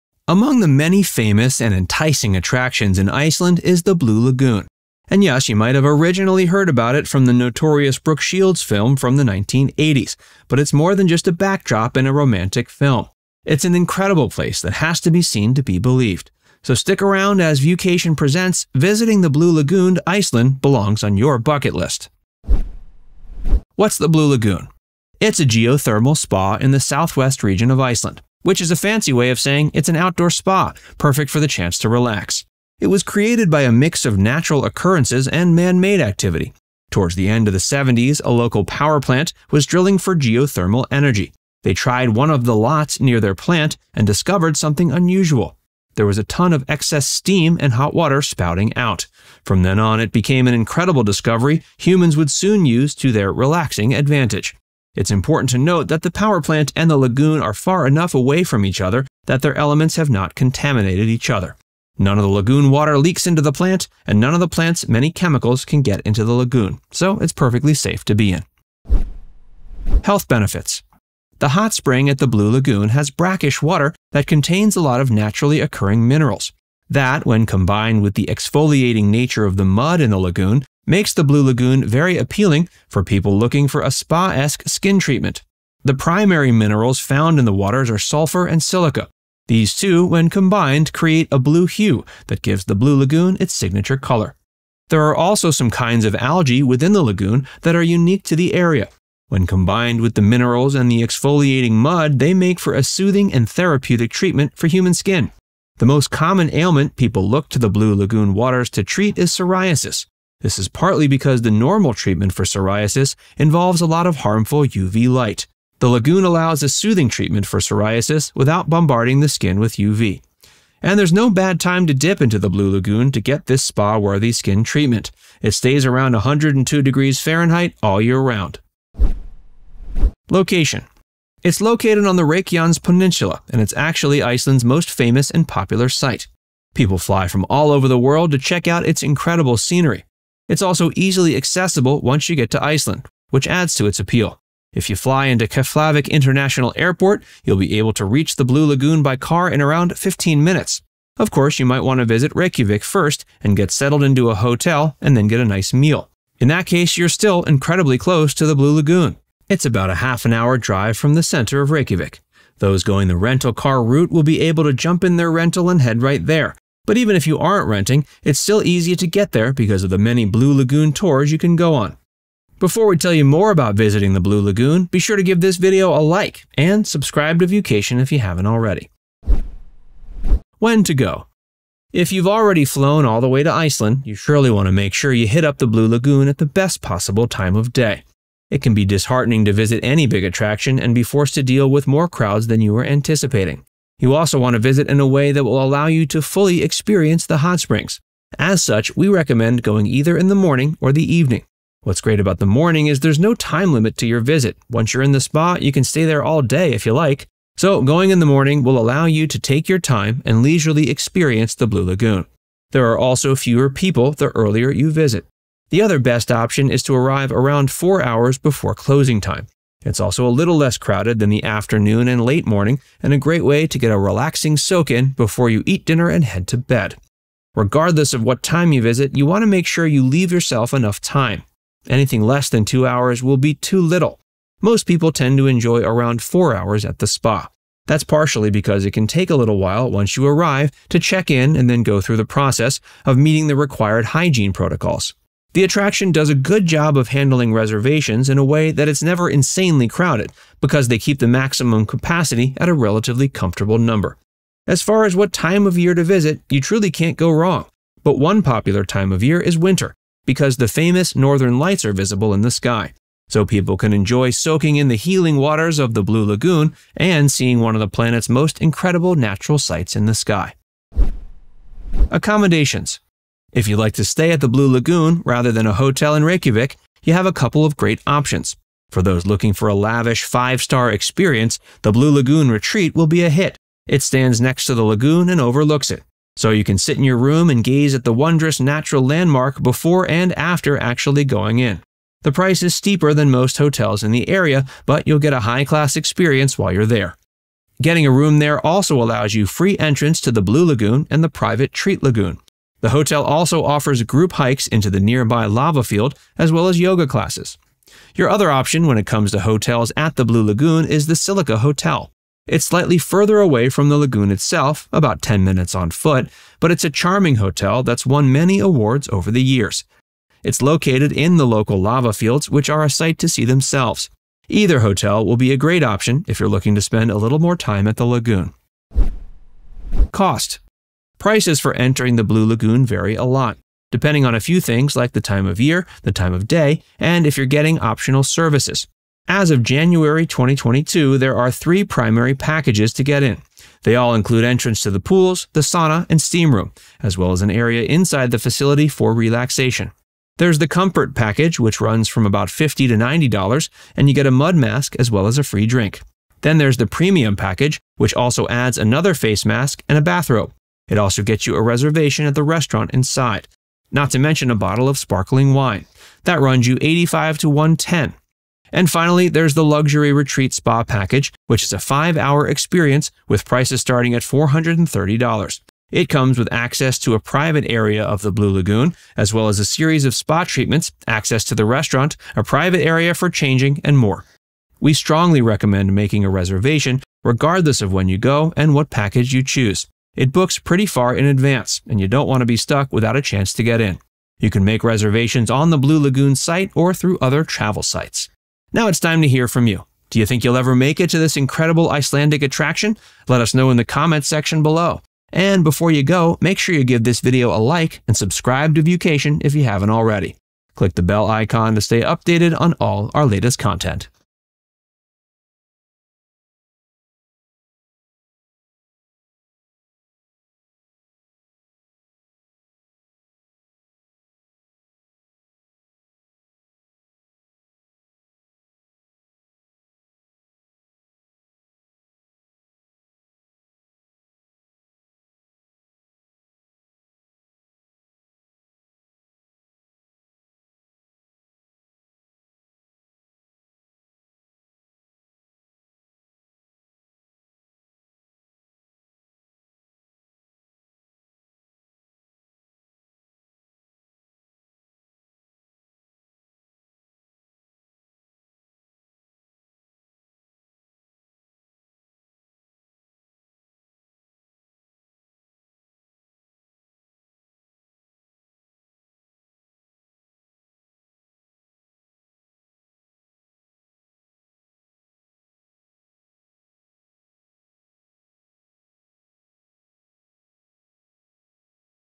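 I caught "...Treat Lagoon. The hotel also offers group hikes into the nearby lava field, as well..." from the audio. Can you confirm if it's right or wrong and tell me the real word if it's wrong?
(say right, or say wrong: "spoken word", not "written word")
right.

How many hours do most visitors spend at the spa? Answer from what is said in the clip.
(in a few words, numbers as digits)
4 hours.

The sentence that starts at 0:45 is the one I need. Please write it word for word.
There was a ton of excess steam and hot water spouting out.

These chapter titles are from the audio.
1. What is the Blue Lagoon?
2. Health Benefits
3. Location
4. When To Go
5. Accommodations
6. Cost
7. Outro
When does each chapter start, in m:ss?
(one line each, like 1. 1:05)
1. 0:23
2. 1:10
3. 2:10
4. 3:00
5. 4:32
6. 5:30
7. 6:38.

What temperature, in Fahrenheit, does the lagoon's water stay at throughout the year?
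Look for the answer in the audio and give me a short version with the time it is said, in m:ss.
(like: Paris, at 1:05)
102 degrees, at 2:06.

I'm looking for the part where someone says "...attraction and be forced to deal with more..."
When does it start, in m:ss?
3:10.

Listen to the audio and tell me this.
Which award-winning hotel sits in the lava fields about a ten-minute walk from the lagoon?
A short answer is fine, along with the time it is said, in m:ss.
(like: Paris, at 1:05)
Silica Hotel, at 5:11.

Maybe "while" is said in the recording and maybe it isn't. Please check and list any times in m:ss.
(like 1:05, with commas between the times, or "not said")
3:59, 4:56.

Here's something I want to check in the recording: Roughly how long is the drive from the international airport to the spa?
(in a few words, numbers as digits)
15 minutes.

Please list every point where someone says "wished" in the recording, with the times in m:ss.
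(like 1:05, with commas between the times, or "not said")
not said.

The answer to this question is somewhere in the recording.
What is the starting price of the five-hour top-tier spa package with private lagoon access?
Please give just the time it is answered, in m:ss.
6:14.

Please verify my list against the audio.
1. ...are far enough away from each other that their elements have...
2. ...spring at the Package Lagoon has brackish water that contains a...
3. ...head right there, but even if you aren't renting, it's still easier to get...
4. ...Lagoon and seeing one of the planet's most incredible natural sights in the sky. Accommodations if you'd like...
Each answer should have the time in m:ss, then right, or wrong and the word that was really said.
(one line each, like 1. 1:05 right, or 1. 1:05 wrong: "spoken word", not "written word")
1. 0:57 right
2. 1:11 wrong: "Blue", not "Package"
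3. 2:45 right
4. 4:26 right.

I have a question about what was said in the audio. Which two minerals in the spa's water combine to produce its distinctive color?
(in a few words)
sulfur and silica.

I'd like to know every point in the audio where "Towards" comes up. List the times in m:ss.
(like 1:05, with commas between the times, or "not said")
0:36.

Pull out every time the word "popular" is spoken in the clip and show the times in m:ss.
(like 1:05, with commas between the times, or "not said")
2:15, 4:18.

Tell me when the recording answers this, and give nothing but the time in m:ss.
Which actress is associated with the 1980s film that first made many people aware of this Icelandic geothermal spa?
0:07.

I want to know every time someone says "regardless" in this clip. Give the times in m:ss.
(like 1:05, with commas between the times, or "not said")
3:47, 6:27.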